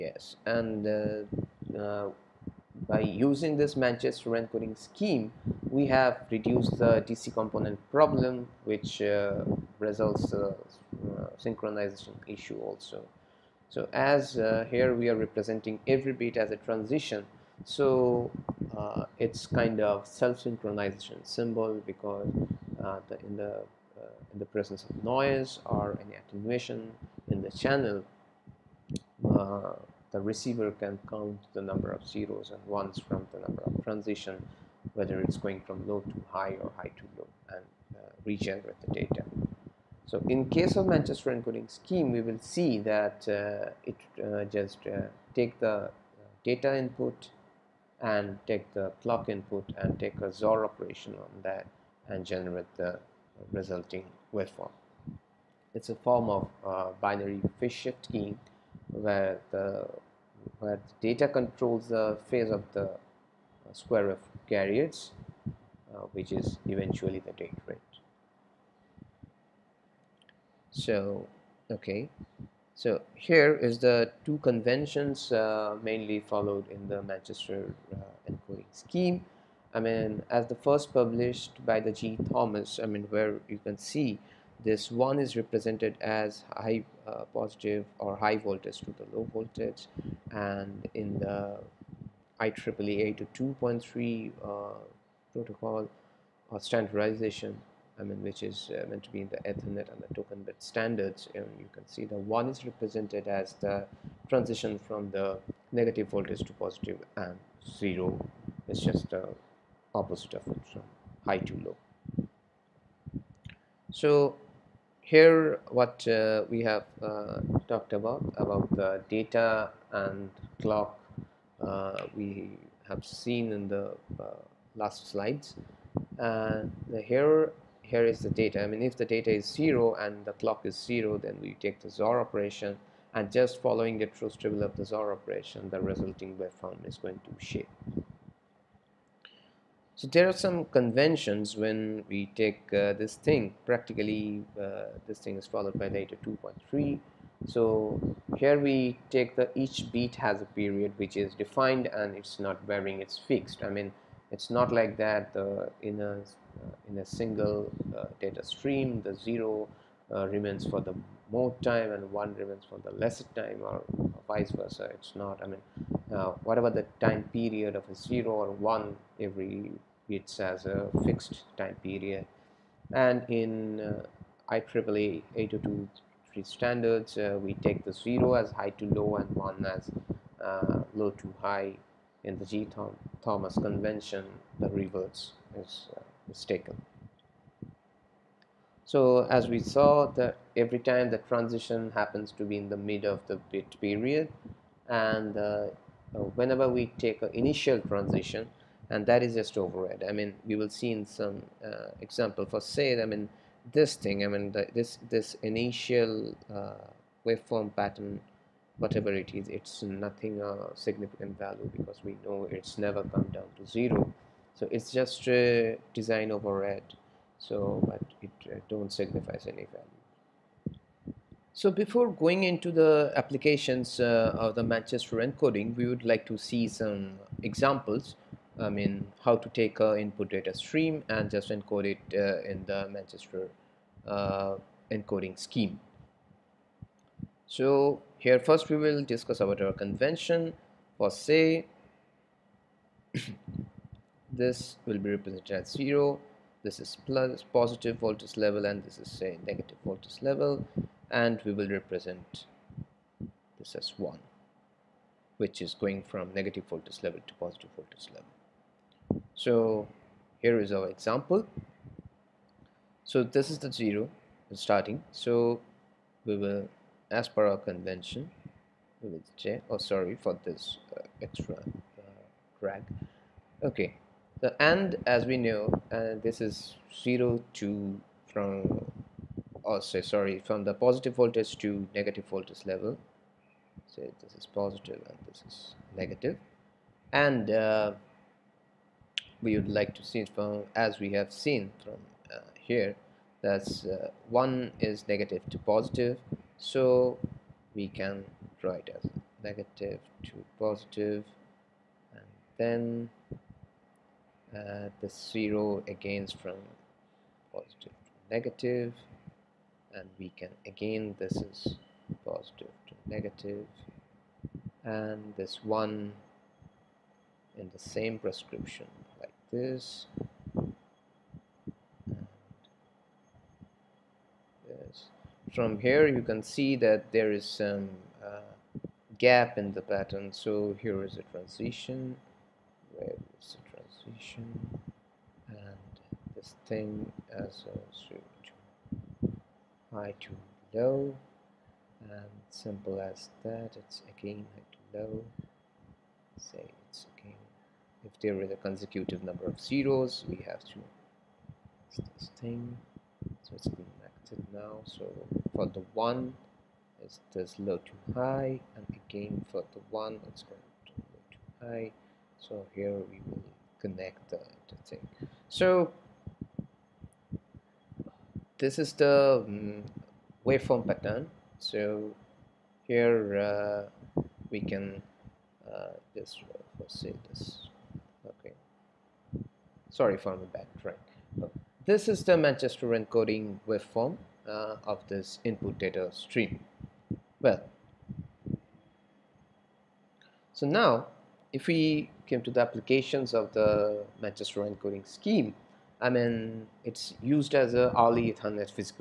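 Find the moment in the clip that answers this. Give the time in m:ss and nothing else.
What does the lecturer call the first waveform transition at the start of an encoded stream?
3:35.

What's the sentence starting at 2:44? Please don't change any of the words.
It's not, I mean, whatever the time period of a zero or one, every it's as a fixed time period.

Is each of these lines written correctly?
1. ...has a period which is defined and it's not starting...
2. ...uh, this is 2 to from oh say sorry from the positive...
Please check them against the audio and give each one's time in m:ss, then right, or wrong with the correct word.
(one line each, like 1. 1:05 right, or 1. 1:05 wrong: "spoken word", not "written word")
1. 2:30 wrong: "varying", not "starting"
2. 4:35 wrong: "0", not "2".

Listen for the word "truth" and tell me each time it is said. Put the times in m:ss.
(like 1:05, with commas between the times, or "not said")
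2:14.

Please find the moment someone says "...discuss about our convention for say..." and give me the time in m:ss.
3:59.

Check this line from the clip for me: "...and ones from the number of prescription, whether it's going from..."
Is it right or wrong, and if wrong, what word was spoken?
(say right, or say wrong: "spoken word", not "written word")
wrong: "transition", not "prescription".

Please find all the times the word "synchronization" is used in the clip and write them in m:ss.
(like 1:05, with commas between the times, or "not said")
0:11, 0:20.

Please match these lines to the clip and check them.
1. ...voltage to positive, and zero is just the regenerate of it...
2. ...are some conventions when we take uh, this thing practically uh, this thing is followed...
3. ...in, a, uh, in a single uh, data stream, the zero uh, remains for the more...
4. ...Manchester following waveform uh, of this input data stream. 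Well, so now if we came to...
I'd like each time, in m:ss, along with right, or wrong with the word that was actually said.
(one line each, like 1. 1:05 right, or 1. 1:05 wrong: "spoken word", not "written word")
1. 1:46 wrong: "opposite", not "regenerate"
2. 2:20 right
3. 2:35 right
4. 6:22 wrong: "encoding", not "following".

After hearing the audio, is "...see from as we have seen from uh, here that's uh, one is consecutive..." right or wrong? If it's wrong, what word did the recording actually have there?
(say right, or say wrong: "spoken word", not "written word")
wrong: "negative", not "consecutive".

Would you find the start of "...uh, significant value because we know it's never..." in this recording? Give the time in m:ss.
3:30.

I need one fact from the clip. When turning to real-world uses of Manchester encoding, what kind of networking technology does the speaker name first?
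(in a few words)
early Ethernet.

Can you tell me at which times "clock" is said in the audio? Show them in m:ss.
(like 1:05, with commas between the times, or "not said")
0:49, 2:00, 2:10.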